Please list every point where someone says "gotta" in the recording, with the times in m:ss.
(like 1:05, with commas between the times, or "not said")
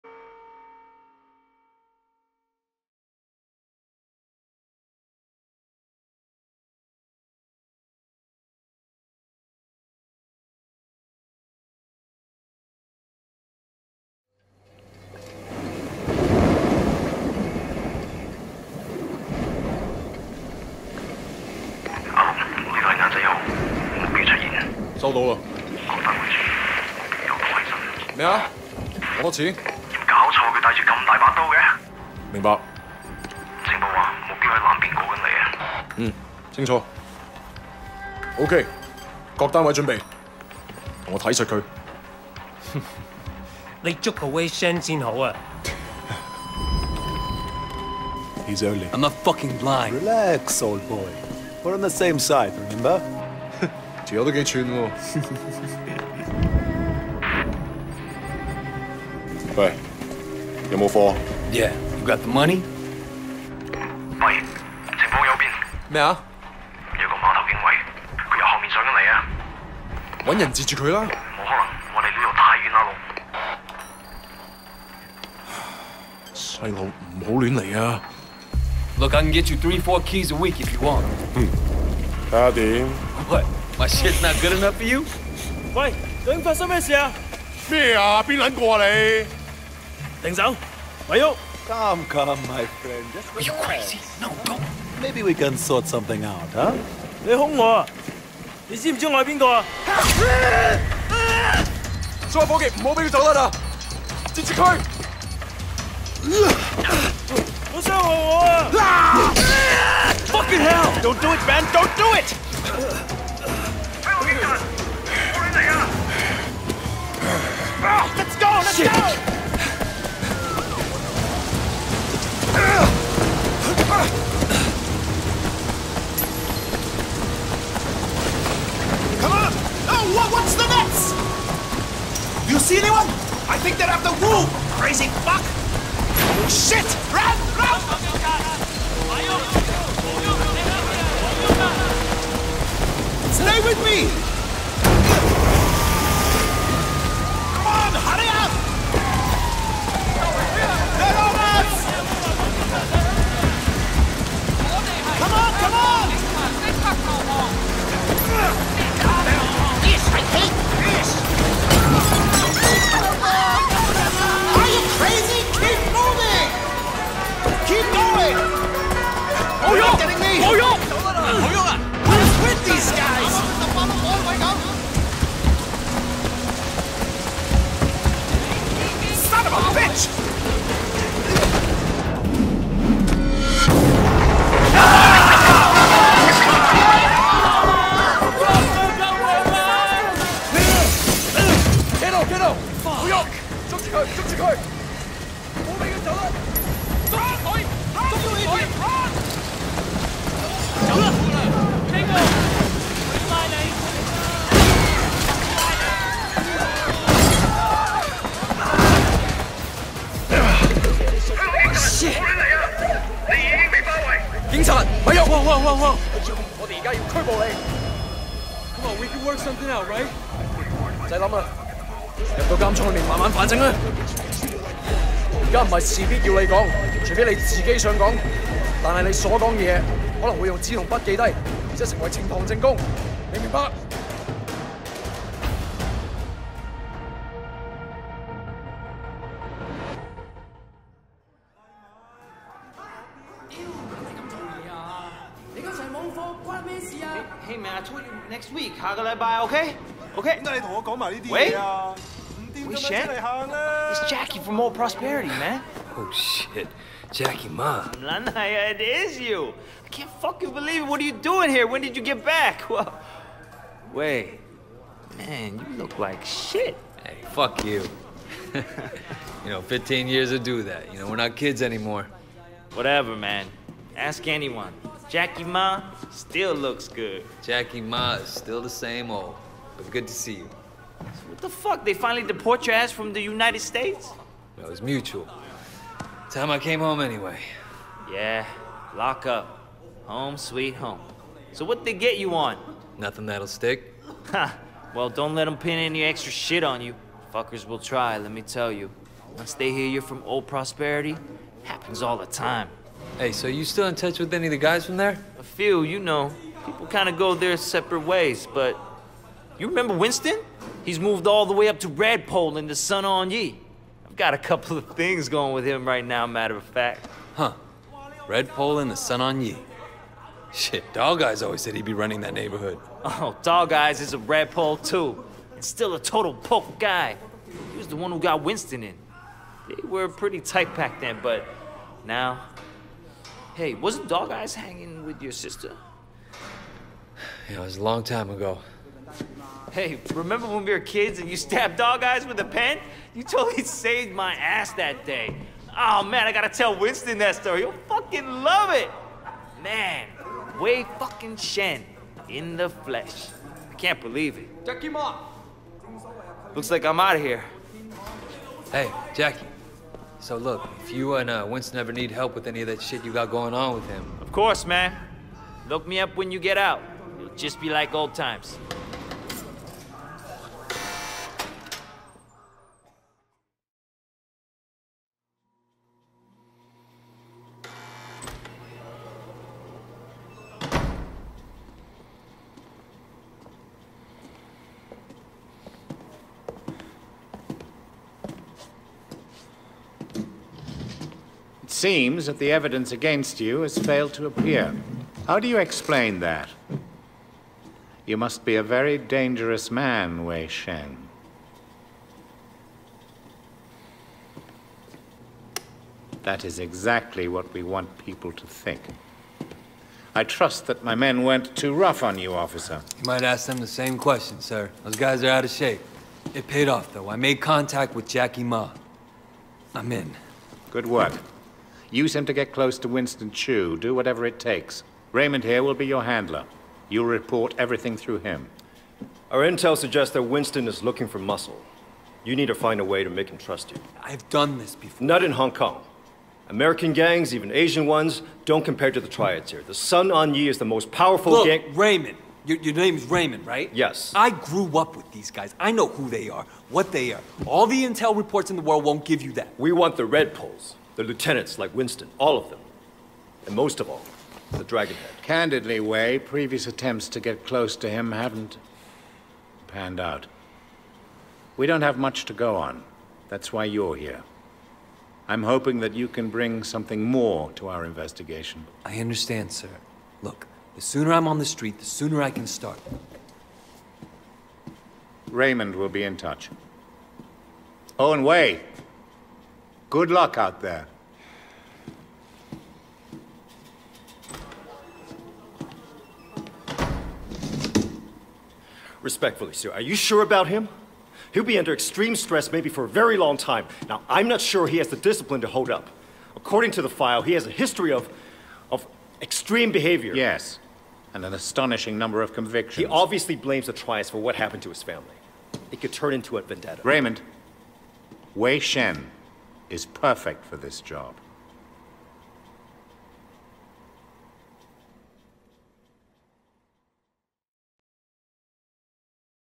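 5:46.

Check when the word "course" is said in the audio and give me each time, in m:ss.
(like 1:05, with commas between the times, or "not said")
6:04.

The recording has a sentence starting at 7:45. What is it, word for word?
I'm hoping that you can bring something more to our investigation.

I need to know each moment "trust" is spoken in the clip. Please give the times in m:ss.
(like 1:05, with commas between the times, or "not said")
6:50, 7:13.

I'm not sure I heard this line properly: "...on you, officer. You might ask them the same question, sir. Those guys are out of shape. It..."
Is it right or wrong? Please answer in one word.
right.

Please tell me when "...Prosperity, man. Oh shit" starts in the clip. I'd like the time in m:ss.
4:14.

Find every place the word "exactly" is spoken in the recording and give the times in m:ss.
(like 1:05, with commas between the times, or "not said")
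6:46.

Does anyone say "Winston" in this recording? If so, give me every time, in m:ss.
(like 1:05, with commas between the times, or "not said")
5:09, 5:28, 5:46, 6:01, 7:02, 7:10, 7:31.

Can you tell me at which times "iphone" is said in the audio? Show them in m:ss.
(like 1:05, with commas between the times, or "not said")
not said.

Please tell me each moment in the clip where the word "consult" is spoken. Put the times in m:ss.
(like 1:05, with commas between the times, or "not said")
not said.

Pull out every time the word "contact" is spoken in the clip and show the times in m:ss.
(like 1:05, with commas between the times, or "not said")
6:57.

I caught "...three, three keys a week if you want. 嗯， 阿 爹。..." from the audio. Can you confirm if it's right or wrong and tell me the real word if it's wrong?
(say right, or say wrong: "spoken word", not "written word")
wrong: "four", not "three".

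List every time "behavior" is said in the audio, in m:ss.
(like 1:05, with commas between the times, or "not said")
8:19.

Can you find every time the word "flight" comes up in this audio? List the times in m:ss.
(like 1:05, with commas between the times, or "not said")
not said.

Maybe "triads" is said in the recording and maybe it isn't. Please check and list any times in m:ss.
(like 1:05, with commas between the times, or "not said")
7:19, 8:23.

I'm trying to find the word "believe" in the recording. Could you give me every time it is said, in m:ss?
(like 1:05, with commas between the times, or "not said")
4:20, 5:53.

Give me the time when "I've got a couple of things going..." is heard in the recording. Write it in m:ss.
5:14.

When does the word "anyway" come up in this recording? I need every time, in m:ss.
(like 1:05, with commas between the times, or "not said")
4:47.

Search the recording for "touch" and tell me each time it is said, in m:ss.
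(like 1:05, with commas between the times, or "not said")
5:03, 7:56.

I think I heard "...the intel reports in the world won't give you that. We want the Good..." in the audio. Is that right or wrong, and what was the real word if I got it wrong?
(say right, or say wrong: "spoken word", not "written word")
wrong: "Red", not "Good".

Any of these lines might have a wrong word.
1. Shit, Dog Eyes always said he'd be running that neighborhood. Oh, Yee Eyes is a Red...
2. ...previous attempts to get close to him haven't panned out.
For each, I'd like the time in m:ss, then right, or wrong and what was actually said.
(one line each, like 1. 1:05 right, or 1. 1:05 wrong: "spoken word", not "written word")
1. 5:20 wrong: "Dog", not "Yee"
2. 7:36 right.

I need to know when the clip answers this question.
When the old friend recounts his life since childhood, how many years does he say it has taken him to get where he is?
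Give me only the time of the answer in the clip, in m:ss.
4:29.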